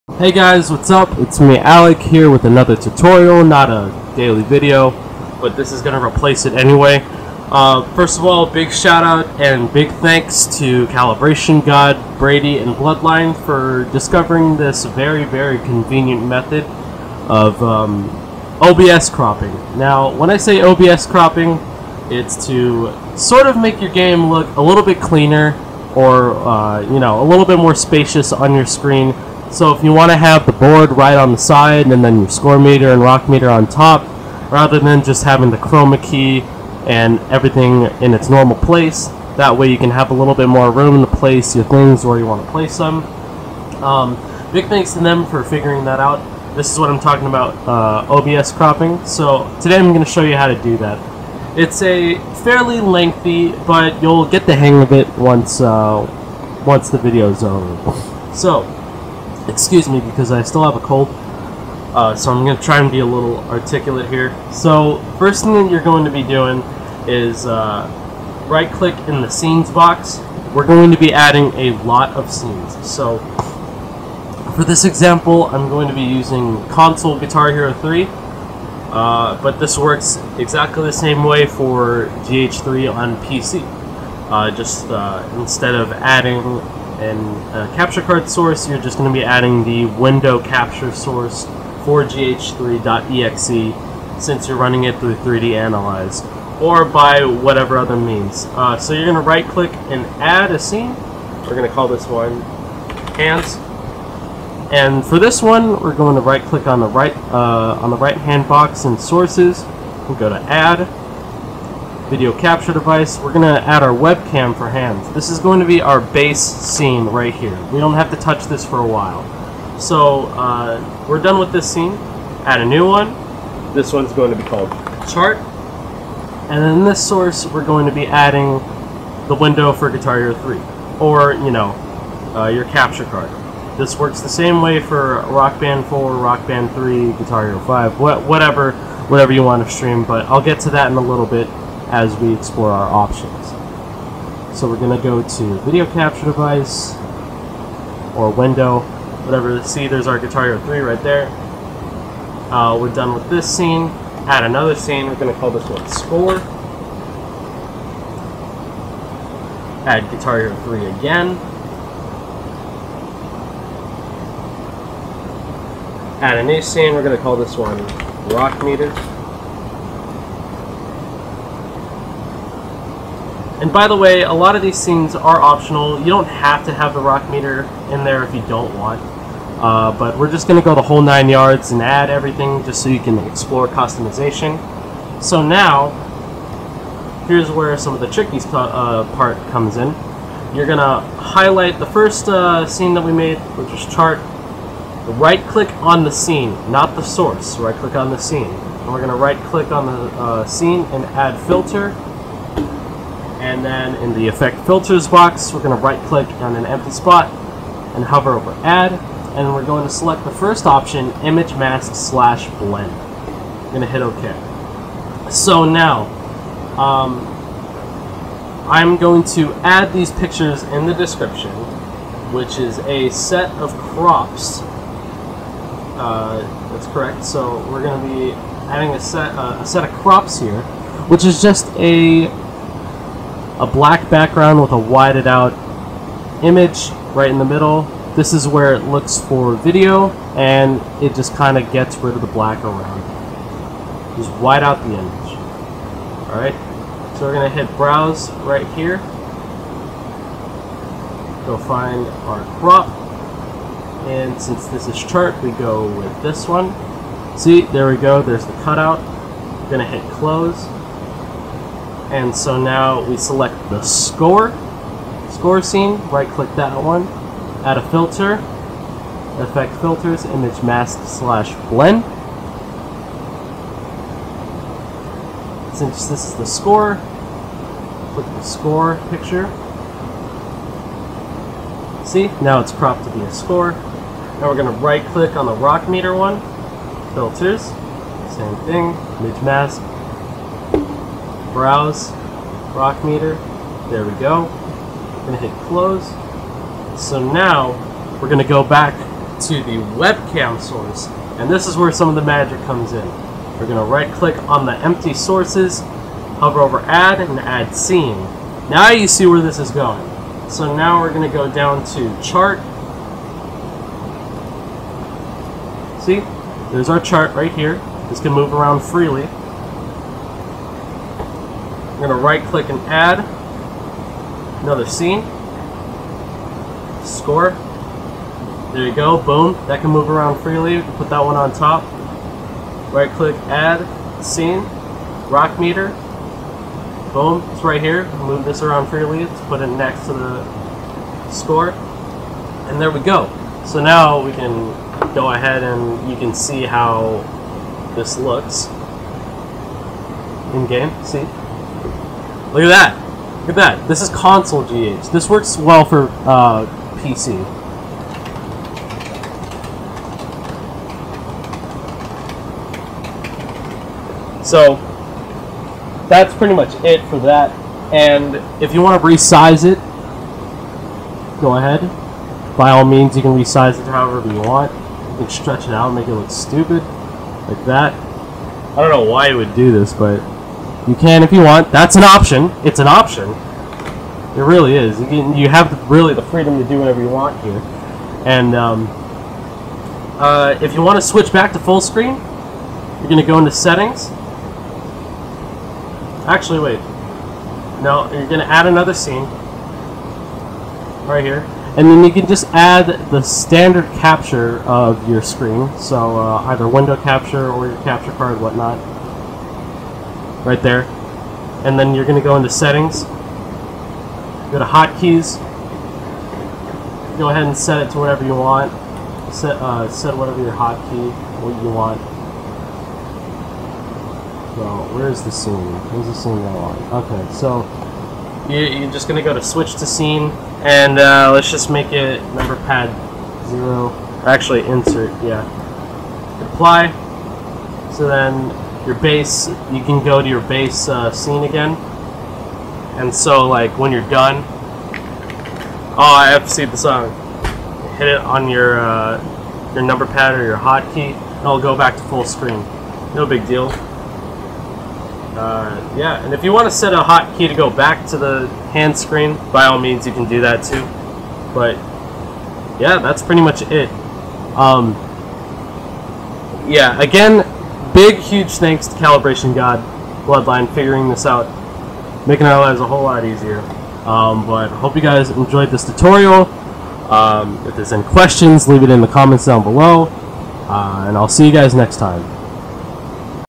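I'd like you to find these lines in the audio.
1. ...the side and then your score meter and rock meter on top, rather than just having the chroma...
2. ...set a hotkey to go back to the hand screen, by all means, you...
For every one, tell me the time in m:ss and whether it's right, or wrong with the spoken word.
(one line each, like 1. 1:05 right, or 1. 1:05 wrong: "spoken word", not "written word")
1. 0:31 right
2. 7:36 right.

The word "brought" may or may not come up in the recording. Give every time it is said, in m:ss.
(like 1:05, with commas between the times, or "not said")
not said.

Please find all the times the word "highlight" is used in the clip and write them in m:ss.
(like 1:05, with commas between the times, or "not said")
3:11.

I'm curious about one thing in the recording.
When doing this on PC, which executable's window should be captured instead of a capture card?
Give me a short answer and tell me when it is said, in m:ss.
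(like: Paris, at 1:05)
gh3.exe, at 1:32.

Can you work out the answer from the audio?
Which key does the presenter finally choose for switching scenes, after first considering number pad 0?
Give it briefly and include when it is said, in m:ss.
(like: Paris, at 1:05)
Insert, at 7:14.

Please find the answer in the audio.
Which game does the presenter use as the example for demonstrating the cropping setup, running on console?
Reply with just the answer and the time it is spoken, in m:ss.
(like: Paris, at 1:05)
Guitar Hero 3, at 1:16.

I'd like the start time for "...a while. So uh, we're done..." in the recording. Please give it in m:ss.
1:58.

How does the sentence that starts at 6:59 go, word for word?
Set, uh, set whatever your hotkey, what you want.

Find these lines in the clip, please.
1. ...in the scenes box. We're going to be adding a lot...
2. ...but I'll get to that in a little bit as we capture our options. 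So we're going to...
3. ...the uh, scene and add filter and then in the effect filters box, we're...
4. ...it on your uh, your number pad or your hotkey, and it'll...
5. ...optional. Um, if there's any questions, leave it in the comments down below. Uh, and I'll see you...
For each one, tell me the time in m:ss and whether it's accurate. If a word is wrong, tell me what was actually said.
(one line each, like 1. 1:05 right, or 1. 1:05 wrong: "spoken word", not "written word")
1. 1:09 right
2. 2:20 wrong: "explore", not "capture"
3. 3:19 right
4. 7:28 right
5. 7:55 wrong: "tutorial", not "optional".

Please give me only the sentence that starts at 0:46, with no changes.
This is what I'm talking about, uh, OBS cropping.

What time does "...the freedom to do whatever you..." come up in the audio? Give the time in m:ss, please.
6:26.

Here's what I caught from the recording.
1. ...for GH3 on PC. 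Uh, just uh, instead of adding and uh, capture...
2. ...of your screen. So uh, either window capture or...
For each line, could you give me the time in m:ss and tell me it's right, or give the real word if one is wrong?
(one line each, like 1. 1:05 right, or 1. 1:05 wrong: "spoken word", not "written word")
1. 1:21 right
2. 6:44 right.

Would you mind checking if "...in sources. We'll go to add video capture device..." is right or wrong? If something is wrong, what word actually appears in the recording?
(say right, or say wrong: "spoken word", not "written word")
right.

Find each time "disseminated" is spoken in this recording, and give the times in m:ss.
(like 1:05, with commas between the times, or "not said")
not said.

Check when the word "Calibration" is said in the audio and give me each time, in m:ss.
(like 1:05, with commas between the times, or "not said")
0:10, 7:48.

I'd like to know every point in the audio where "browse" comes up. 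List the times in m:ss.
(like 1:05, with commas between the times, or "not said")
4:07, 4:51.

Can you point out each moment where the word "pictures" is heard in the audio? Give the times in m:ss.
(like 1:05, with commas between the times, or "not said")
3:40, 4:39.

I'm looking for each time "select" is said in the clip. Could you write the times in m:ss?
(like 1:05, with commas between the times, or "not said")
3:29, 4:23.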